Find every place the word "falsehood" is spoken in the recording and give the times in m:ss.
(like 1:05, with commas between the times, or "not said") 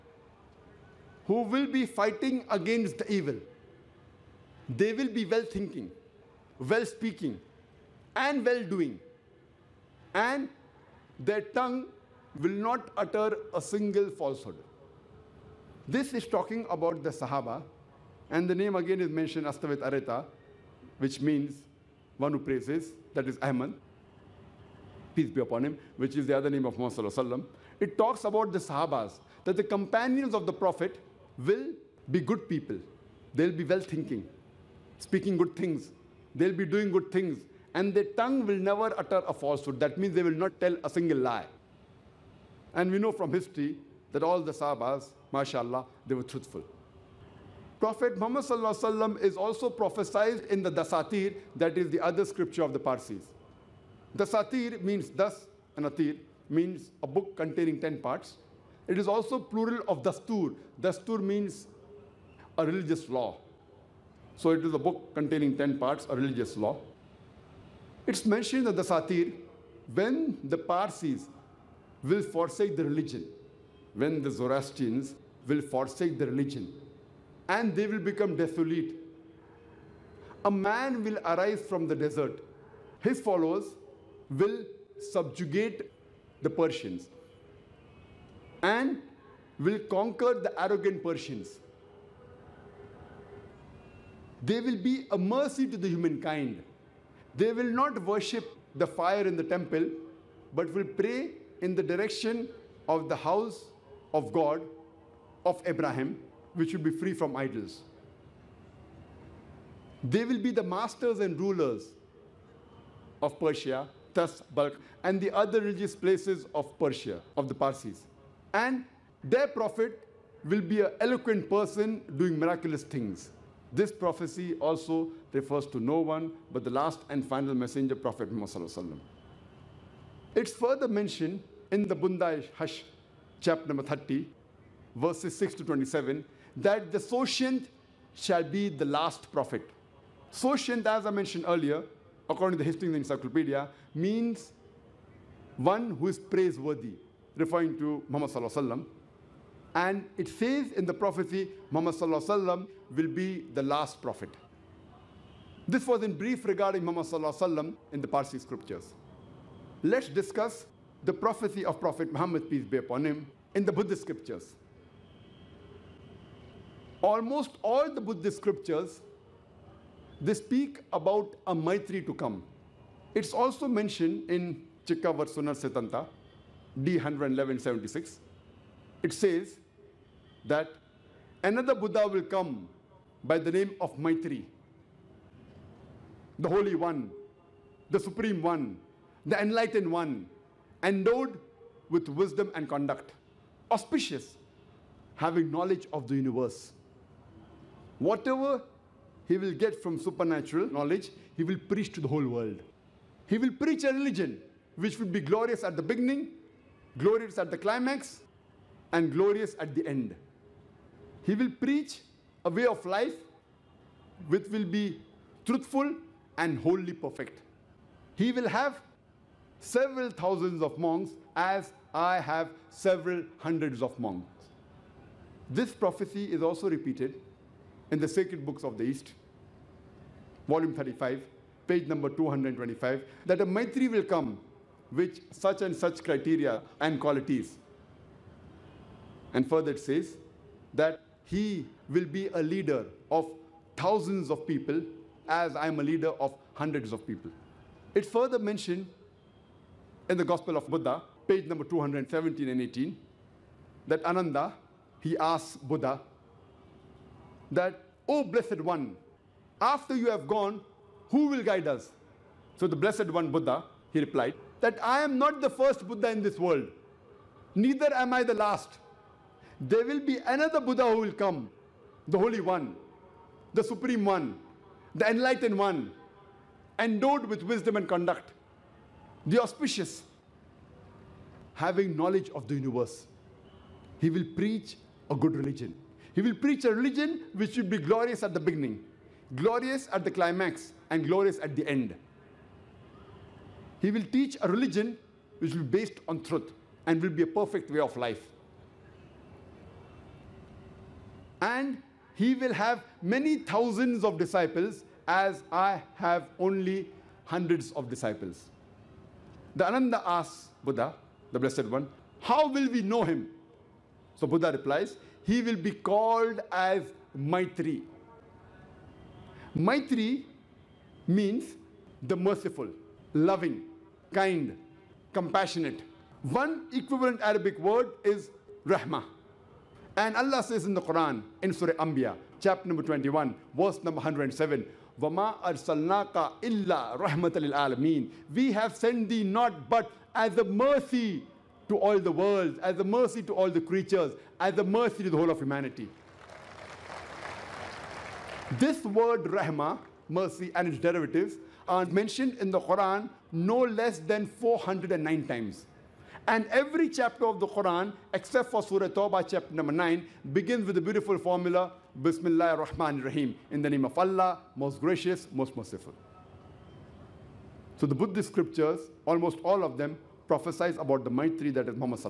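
0:14, 0:39.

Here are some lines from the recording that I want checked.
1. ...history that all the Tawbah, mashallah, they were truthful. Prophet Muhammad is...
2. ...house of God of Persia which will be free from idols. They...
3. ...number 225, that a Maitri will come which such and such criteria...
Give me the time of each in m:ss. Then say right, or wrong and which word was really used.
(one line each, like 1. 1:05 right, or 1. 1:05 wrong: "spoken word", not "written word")
1. 0:43 wrong: "Sahabas", not "Tawbah"
2. 1:43 wrong: "Abraham", not "Persia"
3. 3:51 right.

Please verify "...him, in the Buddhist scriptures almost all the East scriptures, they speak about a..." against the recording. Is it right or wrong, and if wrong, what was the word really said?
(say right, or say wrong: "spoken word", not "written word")
wrong: "Buddhist", not "East".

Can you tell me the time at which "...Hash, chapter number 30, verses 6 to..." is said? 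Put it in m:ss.
2:12.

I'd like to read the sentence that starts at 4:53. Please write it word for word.
He will teach a religion which will be based on truth and will be a perfect way of life.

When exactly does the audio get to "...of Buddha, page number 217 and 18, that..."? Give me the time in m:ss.
4:10.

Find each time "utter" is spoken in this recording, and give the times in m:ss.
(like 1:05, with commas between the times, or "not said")
0:13, 0:38.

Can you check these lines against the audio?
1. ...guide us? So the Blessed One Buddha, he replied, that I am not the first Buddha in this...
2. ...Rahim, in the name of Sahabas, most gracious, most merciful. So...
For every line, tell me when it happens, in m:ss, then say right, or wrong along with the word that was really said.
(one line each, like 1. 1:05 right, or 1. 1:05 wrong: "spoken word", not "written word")
1. 4:21 right
2. 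6:03 wrong: "Allah", not "Sahabas".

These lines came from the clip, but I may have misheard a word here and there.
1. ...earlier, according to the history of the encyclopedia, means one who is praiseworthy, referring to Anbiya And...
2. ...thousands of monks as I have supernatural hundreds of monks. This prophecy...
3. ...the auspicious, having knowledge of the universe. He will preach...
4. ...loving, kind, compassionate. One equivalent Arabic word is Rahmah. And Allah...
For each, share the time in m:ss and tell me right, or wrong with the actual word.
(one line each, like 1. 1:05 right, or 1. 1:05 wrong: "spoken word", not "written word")
1. 2:21 wrong: "Muhammad", not "Anbiya"
2. 3:40 wrong: "several", not "supernatural"
3. 4:39 right
4. 5:23 right.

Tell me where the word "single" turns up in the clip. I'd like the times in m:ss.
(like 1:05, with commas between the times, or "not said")
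0:13, 0:40.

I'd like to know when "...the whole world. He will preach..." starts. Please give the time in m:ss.
3:22.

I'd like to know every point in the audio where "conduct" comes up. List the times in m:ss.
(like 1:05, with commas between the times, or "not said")
3:12, 4:37.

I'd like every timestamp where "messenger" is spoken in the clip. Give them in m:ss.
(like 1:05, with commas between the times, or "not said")
2:07.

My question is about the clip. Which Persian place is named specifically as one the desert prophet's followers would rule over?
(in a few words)
Balkh.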